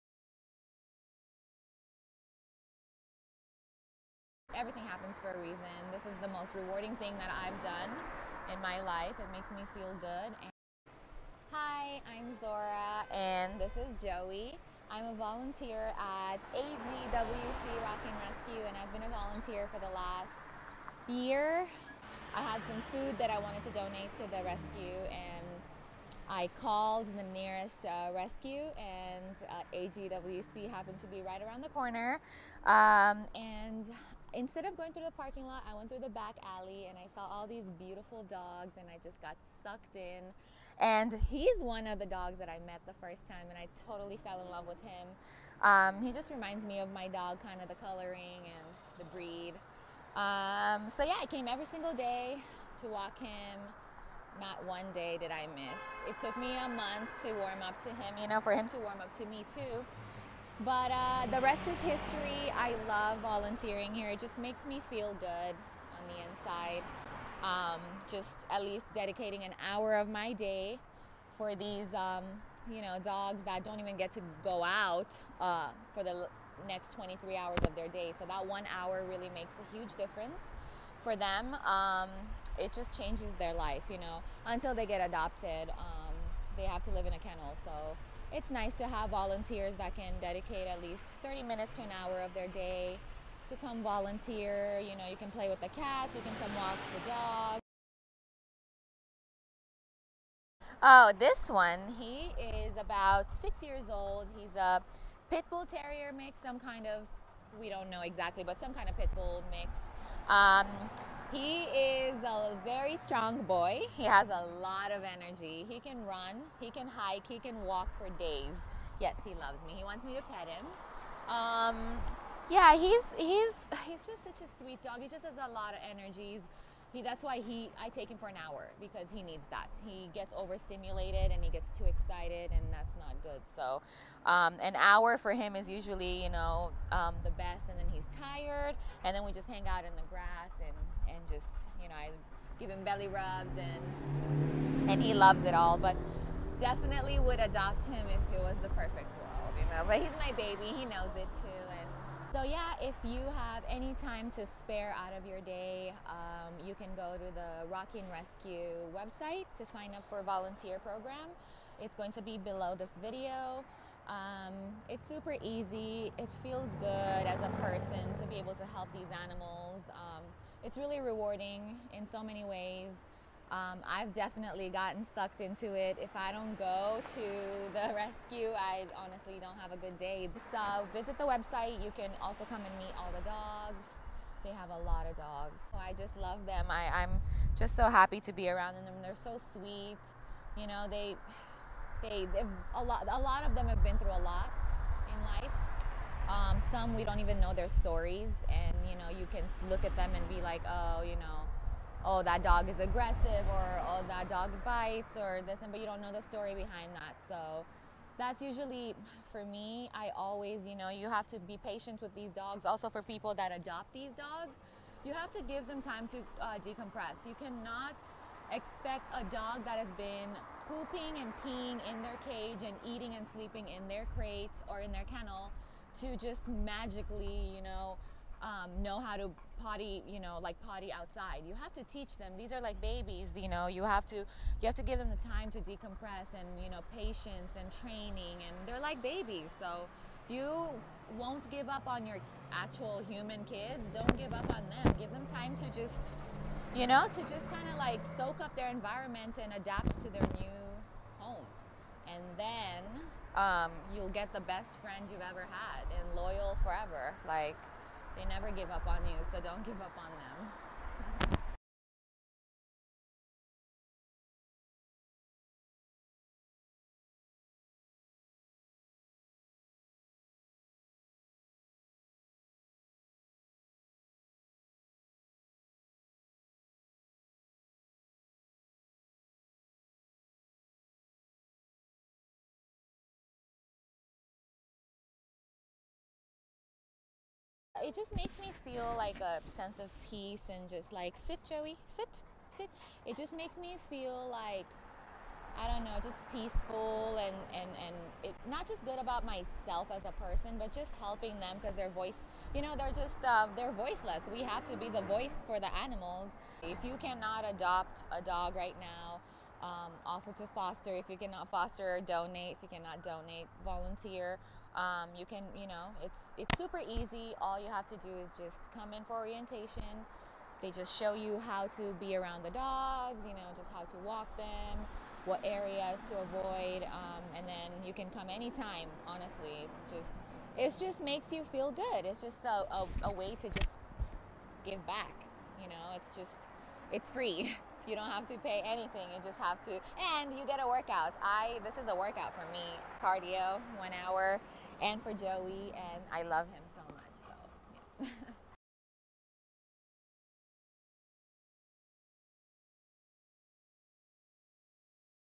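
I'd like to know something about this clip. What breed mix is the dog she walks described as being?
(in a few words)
Pit bull terrier mix.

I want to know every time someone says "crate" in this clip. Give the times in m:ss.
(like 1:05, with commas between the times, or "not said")
3:44.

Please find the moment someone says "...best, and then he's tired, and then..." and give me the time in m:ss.
2:17.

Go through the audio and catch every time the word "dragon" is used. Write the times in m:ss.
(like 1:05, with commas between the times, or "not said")
not said.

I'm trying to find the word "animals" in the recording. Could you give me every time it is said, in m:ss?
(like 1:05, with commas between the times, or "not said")
2:49, 5:05.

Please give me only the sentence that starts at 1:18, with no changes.
So that one hour really makes a huge difference for them.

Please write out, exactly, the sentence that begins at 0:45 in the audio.
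Um, he just reminds me of my dog, kind of the coloring and the breed.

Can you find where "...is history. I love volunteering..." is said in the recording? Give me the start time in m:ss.
1:01.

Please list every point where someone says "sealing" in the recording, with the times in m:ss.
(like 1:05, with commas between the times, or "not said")
not said.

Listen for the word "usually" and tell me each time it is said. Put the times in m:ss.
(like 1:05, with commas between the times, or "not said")
2:15, 3:28.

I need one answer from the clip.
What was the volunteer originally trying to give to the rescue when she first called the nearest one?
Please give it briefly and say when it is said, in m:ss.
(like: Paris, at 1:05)
Food, at 0:22.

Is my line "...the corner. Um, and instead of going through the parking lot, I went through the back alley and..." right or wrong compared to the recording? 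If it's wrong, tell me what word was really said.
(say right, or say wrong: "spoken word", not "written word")
right.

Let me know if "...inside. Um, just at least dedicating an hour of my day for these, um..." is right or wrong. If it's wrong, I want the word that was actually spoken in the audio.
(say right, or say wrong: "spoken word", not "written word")
right.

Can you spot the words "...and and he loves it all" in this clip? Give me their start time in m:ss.
2:23.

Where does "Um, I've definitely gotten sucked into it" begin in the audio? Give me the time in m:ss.
2:53.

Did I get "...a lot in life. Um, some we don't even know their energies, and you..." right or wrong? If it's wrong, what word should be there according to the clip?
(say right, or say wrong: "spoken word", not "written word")
wrong: "stories", not "energies".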